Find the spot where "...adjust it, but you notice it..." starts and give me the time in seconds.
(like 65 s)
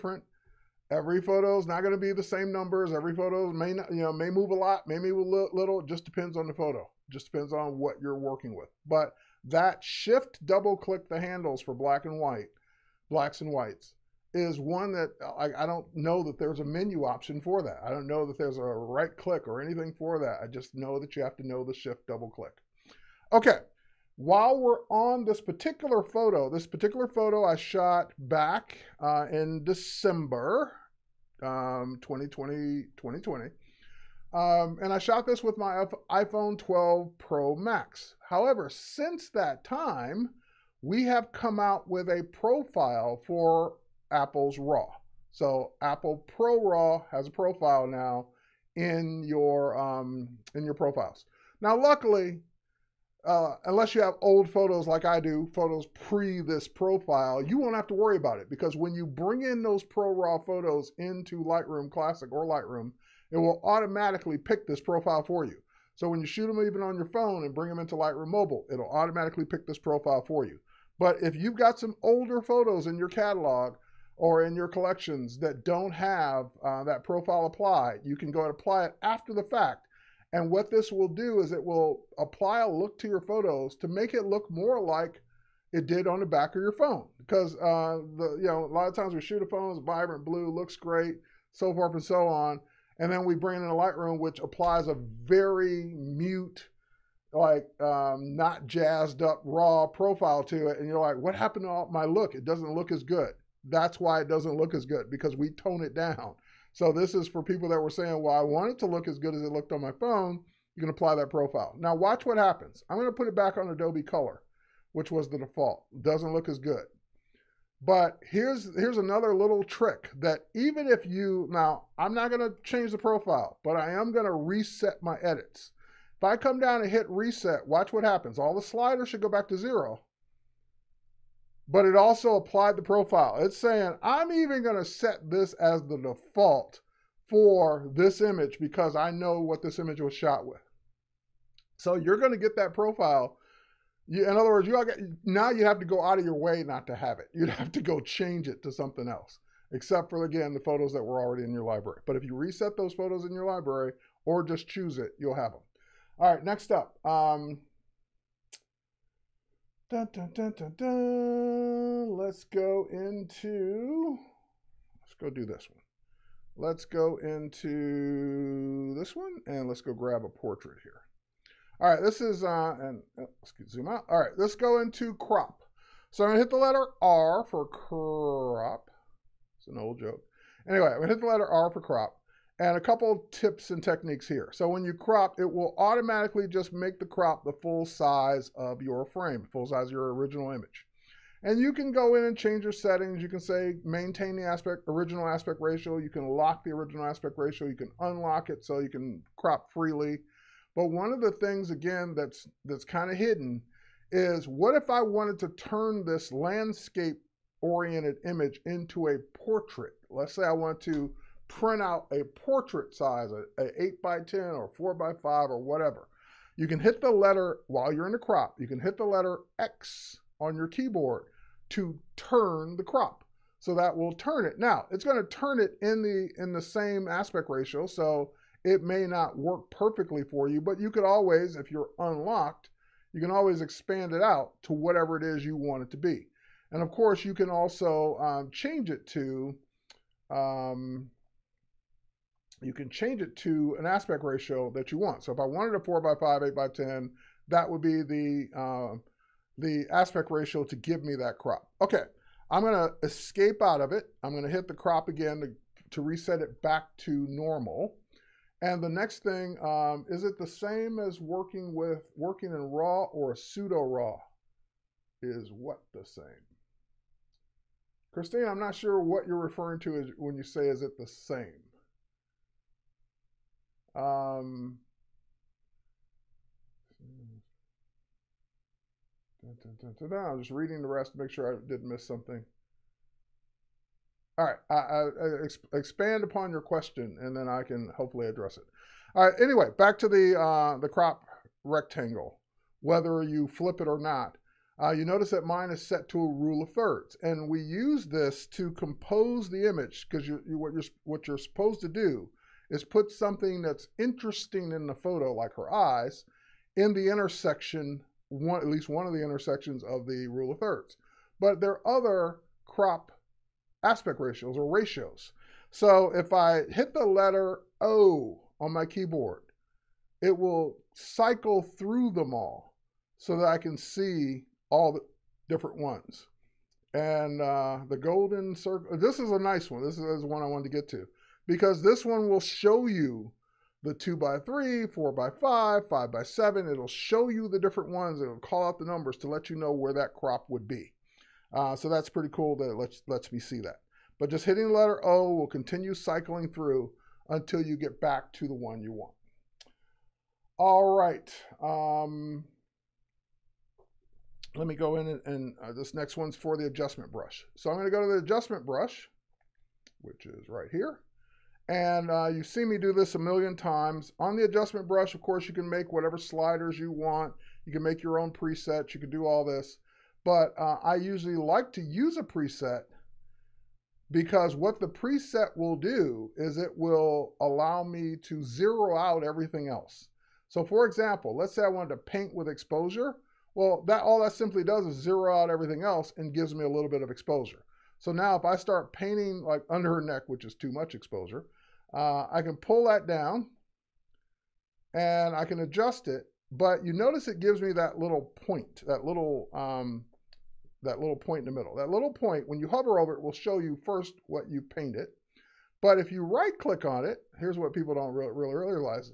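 395 s.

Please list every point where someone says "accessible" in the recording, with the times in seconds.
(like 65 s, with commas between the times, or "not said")
not said.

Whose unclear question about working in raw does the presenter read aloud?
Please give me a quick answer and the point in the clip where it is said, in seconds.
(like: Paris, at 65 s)
Christine, at 268 s.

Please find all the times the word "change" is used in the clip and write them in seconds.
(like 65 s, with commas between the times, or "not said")
122 s, 147 s, 192 s, 238 s, 242 s.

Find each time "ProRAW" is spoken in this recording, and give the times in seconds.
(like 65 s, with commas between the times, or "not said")
46 s, 59 s.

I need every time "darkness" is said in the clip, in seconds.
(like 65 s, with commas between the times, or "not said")
not said.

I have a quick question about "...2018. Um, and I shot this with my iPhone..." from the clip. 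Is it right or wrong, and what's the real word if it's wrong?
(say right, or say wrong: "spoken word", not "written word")
wrong: "2020", not "2018".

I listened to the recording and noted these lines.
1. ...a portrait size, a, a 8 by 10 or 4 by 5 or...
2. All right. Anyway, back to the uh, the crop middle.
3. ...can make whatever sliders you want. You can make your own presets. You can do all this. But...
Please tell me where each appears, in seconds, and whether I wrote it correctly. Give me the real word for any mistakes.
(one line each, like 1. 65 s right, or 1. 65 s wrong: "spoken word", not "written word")
1. 212 s right
2. 289 s wrong: "rectangle", not "middle"
3. 365 s right.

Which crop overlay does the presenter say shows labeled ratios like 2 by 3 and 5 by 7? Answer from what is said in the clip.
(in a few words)
golden circle.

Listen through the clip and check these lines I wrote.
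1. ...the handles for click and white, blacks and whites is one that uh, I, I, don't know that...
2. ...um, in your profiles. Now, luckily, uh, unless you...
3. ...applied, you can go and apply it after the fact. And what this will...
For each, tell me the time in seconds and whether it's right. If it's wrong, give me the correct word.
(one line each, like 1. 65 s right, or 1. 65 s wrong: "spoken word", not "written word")
1. 11 s wrong: "black", not "click"
2. 49 s right
3. 77 s right.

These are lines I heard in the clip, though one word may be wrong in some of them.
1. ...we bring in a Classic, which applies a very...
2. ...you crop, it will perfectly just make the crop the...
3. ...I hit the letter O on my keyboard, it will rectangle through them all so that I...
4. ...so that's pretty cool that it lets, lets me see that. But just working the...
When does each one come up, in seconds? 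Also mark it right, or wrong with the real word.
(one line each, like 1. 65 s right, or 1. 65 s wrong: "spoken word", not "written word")
1. 93 s wrong: "Lightroom", not "Classic"
2. 184 s wrong: "automatically", not "perfectly"
3. 316 s wrong: "cycle", not "rectangle"
4. 341 s wrong: "hitting", not "working".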